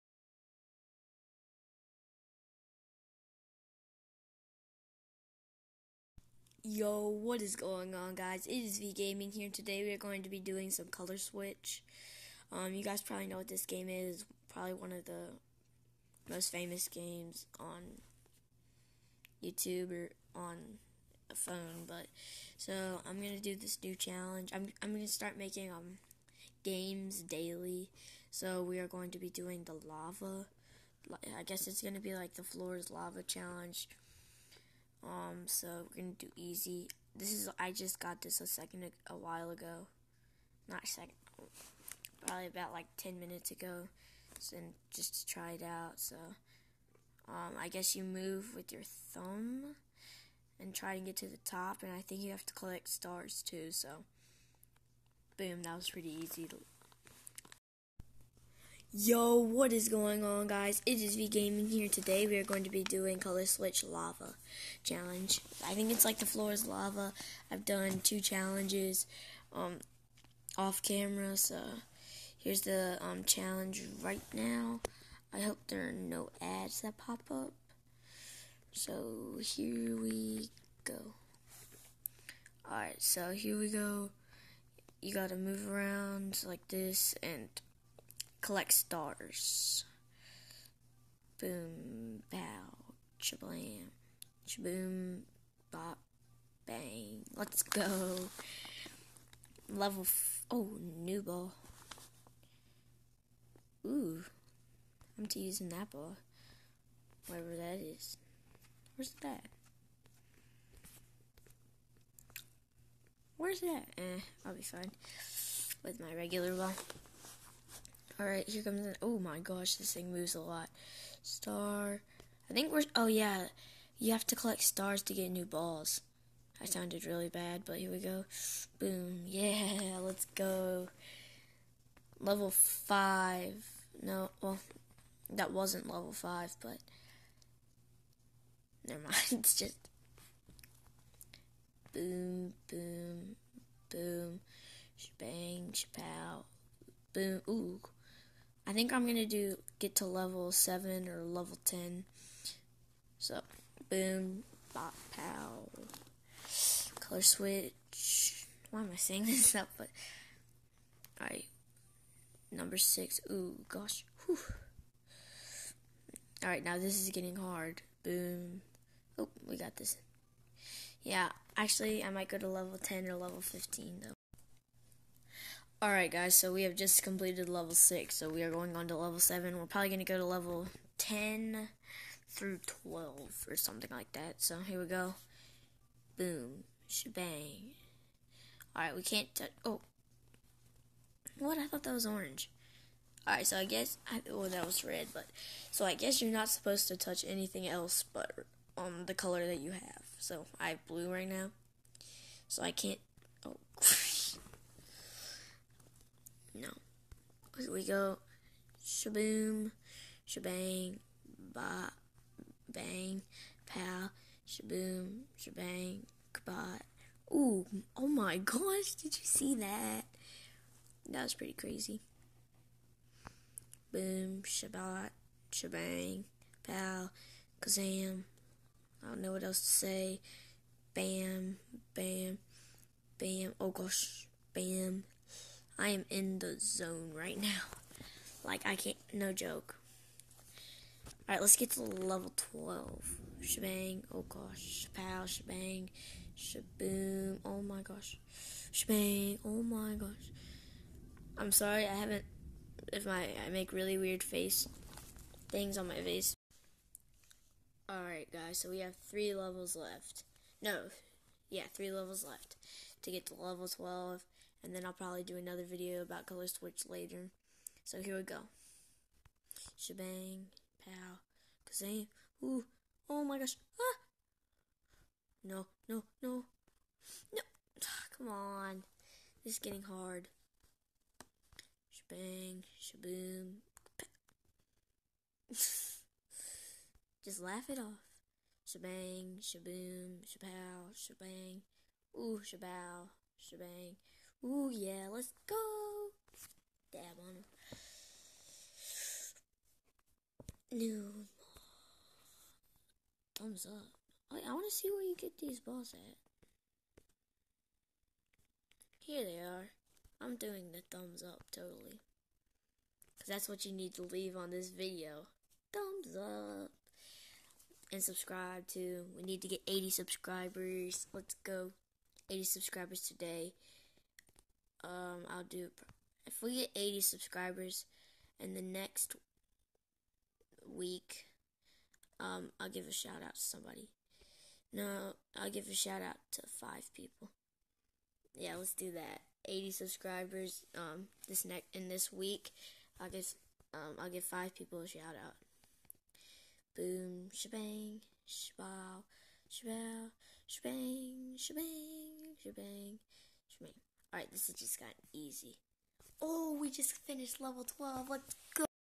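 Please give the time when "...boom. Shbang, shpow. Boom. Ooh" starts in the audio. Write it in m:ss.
2:23.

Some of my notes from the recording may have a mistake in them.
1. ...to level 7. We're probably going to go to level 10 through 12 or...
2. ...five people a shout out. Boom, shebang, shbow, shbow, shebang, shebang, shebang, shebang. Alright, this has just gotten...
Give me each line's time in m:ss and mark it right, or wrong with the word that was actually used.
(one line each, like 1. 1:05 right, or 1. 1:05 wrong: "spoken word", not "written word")
1. 2:58 right
2. 5:44 right.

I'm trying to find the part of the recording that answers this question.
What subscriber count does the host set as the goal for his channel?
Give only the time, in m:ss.
5:22.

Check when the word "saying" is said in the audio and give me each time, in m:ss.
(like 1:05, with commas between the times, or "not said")
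2:38.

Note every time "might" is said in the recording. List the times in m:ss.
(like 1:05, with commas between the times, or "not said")
2:52.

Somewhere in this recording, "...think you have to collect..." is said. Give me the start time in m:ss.
0:52.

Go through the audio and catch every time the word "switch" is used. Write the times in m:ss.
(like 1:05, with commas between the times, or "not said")
0:11, 1:03, 2:37, 4:26.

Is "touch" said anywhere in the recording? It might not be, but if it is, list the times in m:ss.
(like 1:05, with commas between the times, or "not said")
3:09, 3:16.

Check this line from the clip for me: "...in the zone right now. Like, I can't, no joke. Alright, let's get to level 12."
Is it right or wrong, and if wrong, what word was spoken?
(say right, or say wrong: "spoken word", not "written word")
right.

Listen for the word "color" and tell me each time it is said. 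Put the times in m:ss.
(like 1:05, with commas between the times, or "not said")
0:10, 1:03, 2:36, 3:19, 4:26.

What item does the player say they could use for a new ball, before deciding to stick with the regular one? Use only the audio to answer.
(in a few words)
an apple.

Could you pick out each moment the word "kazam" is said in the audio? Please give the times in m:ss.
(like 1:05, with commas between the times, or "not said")
3:47, 4:31.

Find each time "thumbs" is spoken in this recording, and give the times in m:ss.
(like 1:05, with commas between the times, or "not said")
0:48, 5:03, 5:10, 5:15.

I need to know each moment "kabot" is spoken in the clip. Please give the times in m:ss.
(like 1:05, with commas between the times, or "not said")
3:36.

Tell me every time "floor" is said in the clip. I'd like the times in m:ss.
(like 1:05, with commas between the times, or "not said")
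0:32, 1:06.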